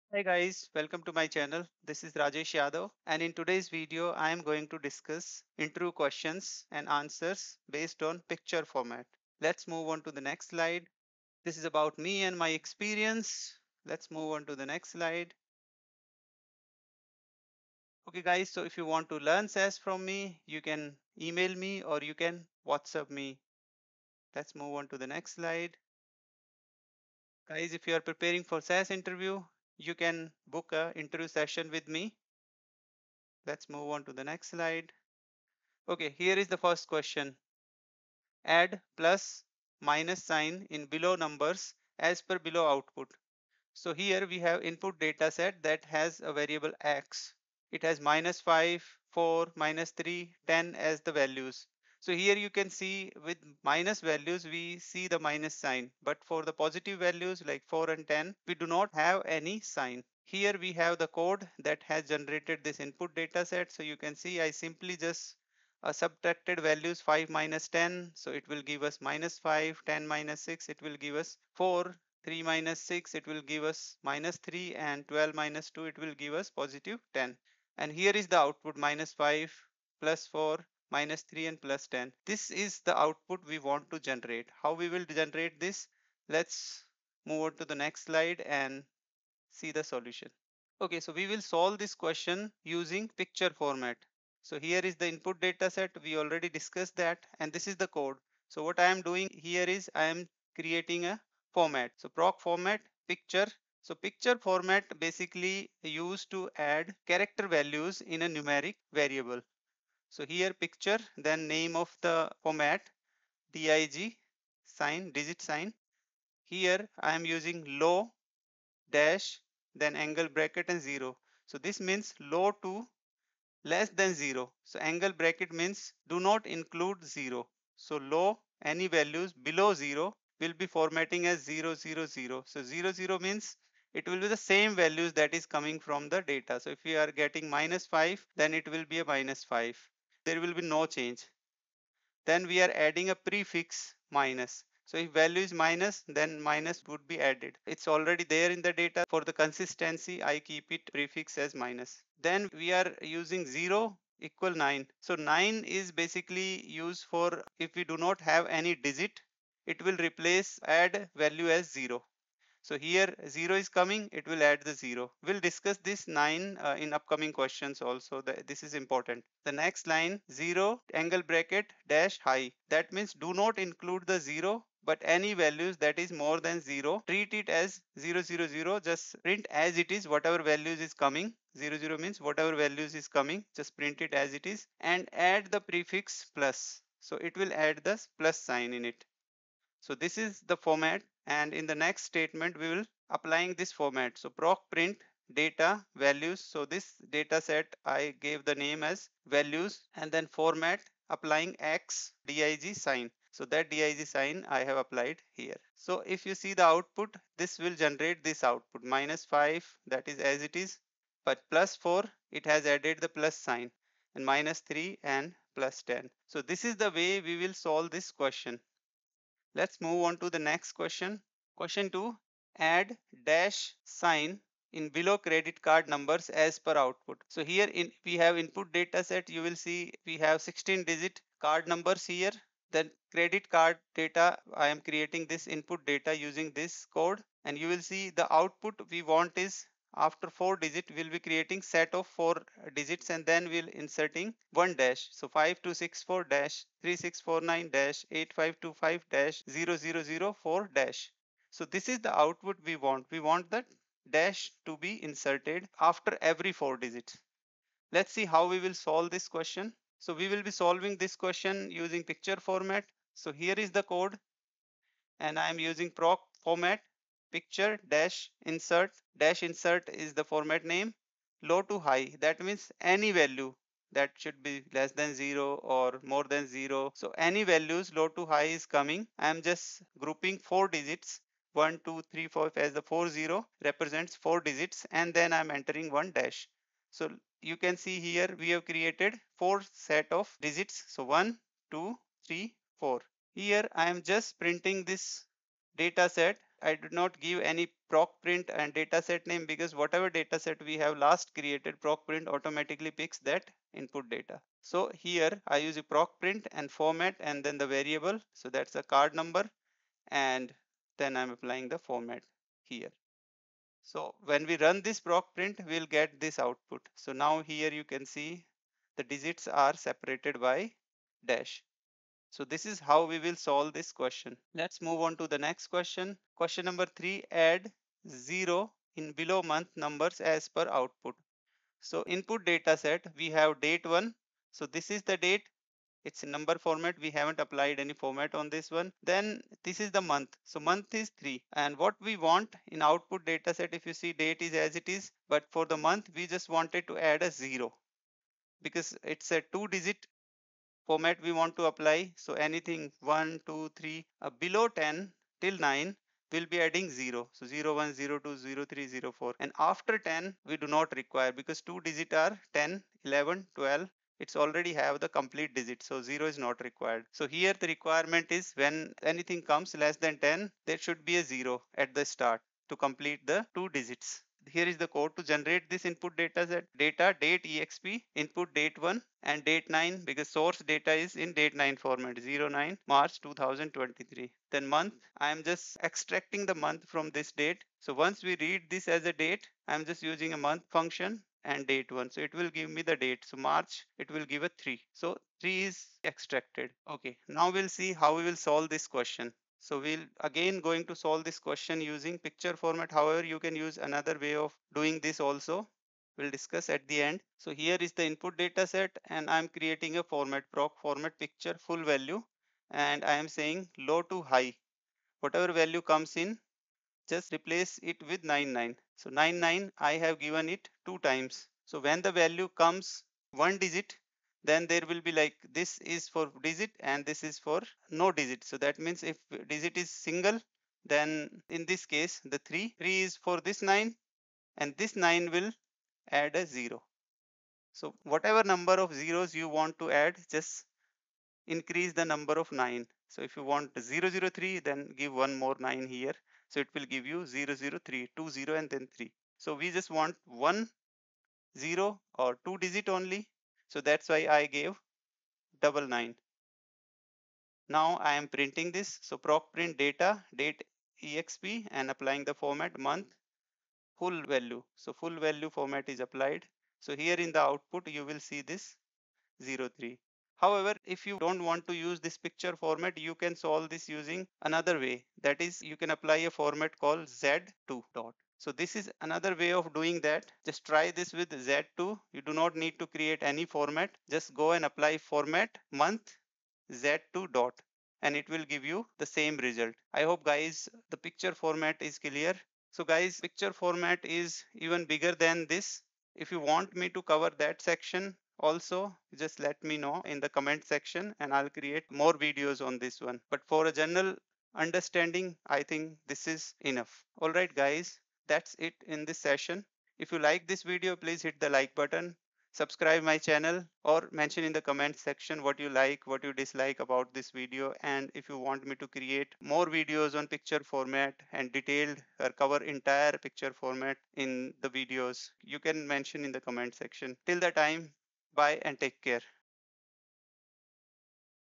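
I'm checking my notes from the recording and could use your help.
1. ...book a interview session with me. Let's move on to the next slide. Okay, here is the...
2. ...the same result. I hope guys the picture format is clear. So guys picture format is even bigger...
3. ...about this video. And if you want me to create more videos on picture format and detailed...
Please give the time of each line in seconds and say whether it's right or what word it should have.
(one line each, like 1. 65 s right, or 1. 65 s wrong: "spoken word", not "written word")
1. 30 s right
2. 488 s right
3. 516 s right.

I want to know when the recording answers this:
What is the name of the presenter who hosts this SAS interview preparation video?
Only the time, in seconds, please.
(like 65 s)
2 s.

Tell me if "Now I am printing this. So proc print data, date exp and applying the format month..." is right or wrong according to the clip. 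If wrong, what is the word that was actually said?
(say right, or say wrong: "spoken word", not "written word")
right.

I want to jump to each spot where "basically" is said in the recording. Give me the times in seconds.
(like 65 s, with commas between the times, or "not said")
104 s, 155 s.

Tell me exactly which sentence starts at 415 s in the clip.
Whatever value comes in, just replace it with 99.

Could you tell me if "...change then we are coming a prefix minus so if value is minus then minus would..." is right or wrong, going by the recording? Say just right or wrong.
wrong.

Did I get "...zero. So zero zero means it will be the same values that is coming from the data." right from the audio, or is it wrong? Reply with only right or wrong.
right.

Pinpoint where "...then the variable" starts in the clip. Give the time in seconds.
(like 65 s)
307 s.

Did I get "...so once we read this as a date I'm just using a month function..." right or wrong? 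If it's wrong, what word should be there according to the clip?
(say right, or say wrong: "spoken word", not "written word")
right.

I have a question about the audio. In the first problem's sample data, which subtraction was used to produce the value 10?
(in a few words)
12 minus 2.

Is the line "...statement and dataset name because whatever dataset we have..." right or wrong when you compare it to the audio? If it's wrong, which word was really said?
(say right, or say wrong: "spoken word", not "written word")
wrong: "print", not "statement".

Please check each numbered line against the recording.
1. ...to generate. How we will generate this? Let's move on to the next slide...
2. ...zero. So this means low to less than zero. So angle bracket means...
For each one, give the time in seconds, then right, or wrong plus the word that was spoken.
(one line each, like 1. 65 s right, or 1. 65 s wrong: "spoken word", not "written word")
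1. 83 s right
2. 120 s right.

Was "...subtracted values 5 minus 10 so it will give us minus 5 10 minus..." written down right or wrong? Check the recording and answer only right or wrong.
right.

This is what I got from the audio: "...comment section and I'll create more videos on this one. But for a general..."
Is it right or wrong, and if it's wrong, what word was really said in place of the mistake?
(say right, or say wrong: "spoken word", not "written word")
right.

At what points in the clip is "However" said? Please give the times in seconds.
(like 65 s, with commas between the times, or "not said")
402 s, 470 s.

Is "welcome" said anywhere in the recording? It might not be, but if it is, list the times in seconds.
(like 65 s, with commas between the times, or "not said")
0 s.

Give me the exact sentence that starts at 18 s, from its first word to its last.
Okay guys, so if you want to learn SAS from me, you can email me or you can WhatsApp me.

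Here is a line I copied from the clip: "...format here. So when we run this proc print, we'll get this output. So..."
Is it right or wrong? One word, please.
right.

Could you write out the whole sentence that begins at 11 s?
This is about me and my experience.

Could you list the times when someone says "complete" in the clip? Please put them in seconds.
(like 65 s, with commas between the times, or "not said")
365 s, 372 s.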